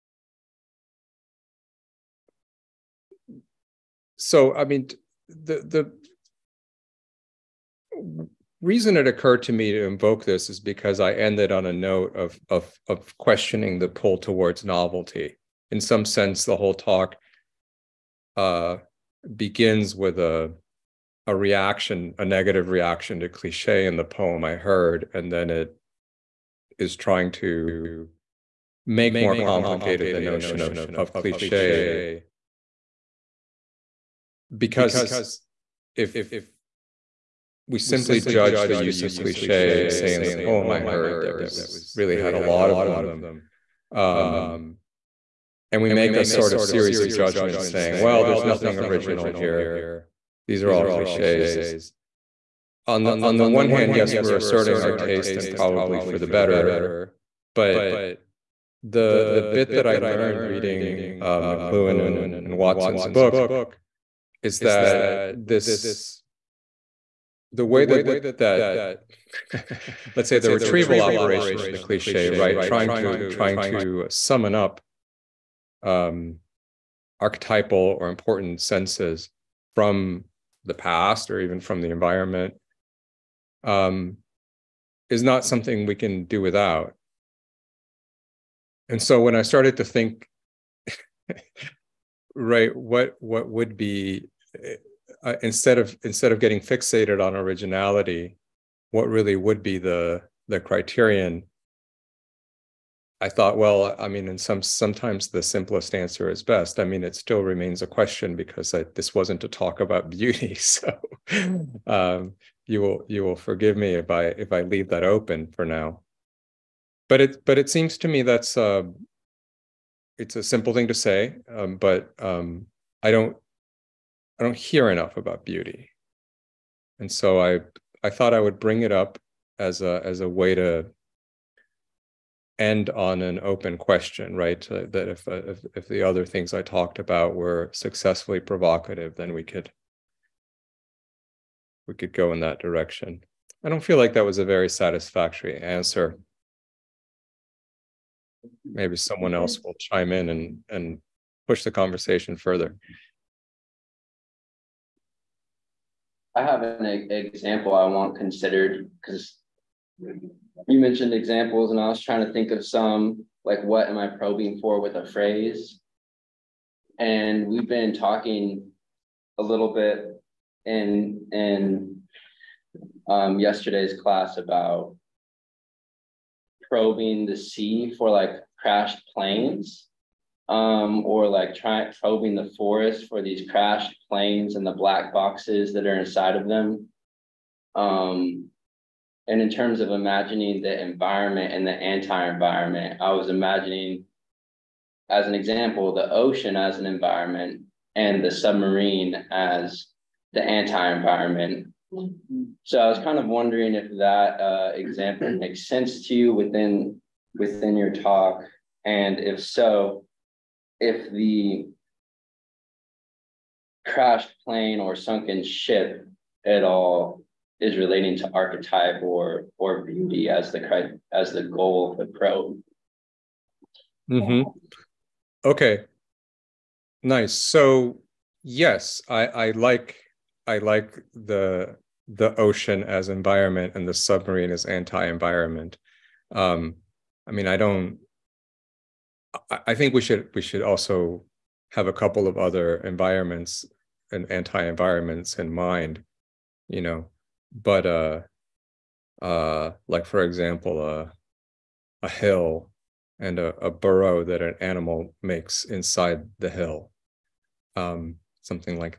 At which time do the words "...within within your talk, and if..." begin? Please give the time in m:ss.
3:26.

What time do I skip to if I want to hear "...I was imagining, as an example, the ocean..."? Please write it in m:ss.
3:13.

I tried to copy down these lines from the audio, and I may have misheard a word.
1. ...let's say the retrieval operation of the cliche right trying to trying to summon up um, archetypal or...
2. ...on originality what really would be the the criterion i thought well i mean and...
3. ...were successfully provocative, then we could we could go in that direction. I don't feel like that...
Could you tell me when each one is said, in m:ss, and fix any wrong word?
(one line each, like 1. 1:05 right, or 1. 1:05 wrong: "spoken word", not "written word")
1. 1:10 right
2. 1:37 right
3. 2:17 right.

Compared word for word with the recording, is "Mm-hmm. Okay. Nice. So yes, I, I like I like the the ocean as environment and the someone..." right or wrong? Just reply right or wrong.
wrong.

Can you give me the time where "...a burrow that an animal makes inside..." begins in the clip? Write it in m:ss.
4:13.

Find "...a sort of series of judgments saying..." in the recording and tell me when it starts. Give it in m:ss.
0:46.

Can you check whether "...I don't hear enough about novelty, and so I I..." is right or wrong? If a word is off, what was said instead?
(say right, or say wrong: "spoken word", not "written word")
wrong: "beauty", not "novelty".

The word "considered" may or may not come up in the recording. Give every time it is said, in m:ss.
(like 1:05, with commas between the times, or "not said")
2:38.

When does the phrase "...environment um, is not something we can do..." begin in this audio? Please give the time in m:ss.
1:21.